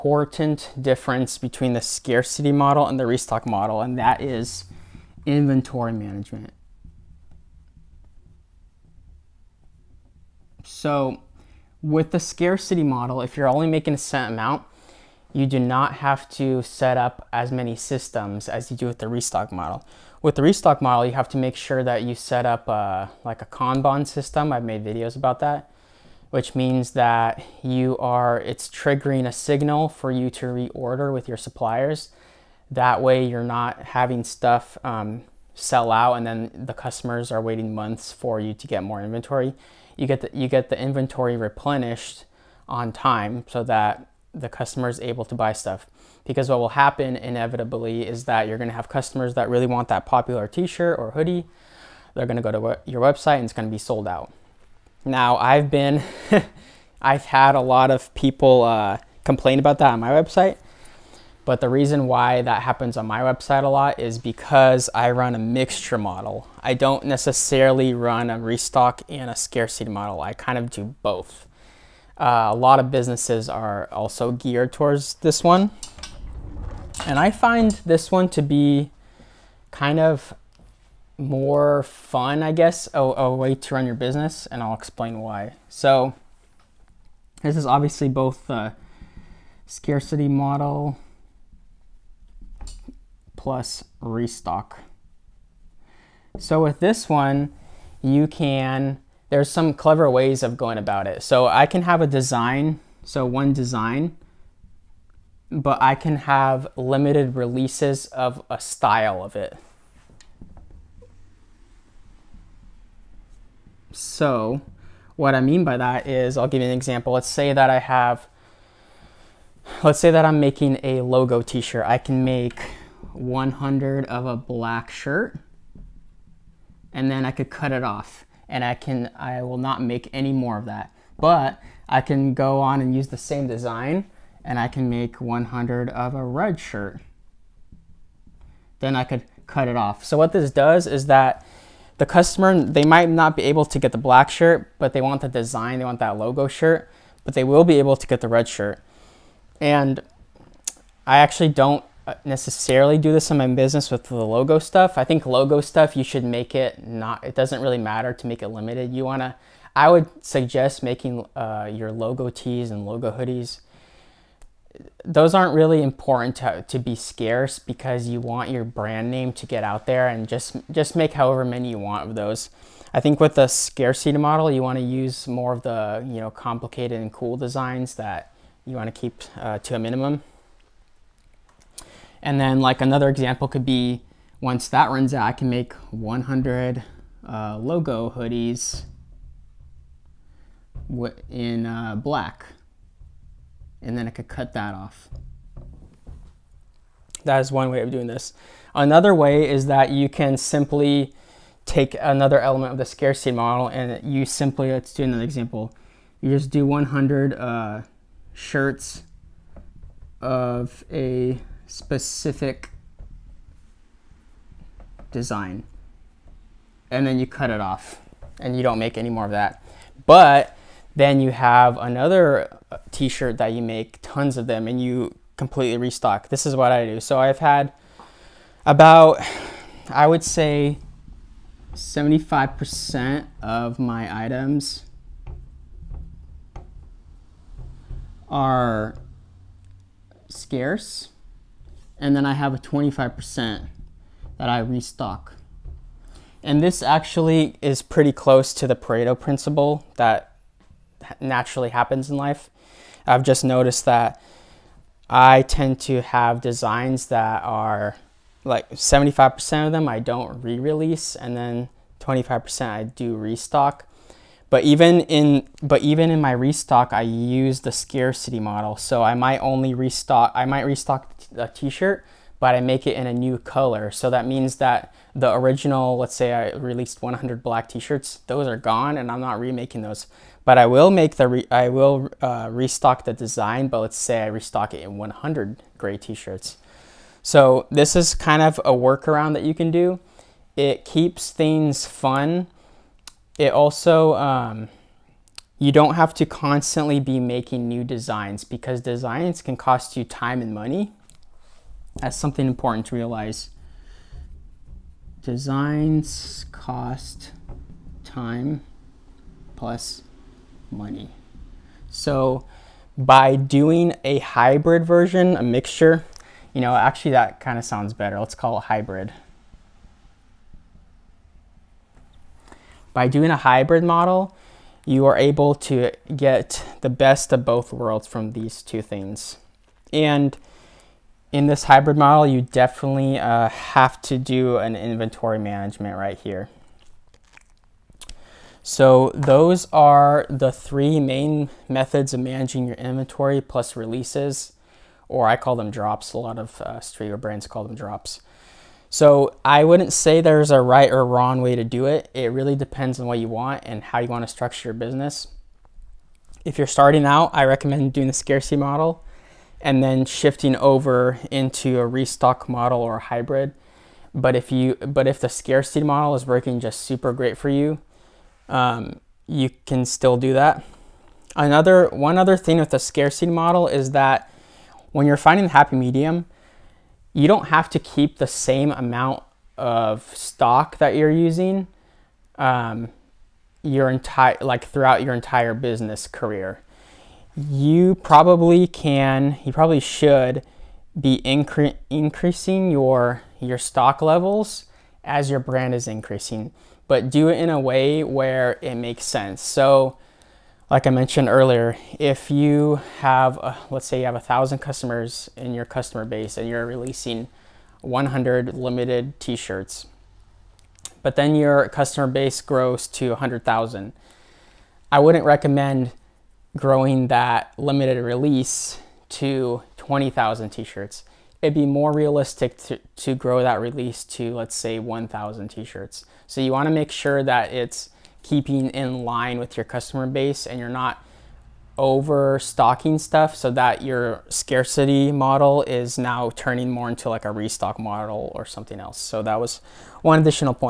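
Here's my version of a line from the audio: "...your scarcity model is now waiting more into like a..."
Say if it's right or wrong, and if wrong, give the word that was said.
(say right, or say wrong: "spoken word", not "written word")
wrong: "turning", not "waiting".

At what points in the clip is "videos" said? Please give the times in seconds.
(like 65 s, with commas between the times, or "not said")
24 s.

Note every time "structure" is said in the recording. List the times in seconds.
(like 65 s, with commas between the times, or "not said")
354 s.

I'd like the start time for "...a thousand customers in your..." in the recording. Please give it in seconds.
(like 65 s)
404 s.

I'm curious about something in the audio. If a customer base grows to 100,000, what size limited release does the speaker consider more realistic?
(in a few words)
1,000 t-shirts.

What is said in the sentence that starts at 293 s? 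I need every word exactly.
It also um, you don't have to constantly be making new designs because designs can cost you time and money.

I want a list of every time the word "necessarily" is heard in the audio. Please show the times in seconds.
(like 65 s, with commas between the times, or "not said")
67 s, 152 s.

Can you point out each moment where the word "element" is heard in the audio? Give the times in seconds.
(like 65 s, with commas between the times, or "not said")
202 s.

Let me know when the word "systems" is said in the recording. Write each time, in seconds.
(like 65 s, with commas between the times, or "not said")
17 s, 24 s.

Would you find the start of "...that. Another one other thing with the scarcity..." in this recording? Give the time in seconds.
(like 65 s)
370 s.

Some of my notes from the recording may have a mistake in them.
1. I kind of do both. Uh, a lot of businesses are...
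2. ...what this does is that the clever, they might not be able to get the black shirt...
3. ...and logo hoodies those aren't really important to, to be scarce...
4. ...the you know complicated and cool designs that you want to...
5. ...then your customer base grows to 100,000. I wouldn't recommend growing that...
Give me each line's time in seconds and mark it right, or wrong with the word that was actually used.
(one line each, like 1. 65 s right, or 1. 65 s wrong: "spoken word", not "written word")
1. 70 s right
2. 140 s wrong: "customer", not "clever"
3. 162 s right
4. 175 s right
5. 411 s right.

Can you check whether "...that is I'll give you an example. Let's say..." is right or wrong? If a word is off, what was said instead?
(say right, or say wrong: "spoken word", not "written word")
right.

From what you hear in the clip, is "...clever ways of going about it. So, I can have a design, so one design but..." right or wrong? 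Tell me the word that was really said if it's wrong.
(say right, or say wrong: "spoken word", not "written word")
right.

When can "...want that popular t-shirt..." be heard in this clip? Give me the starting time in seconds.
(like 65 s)
49 s.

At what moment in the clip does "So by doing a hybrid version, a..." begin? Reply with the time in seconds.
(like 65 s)
311 s.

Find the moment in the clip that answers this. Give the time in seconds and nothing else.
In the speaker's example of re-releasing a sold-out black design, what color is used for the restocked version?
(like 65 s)
285 s.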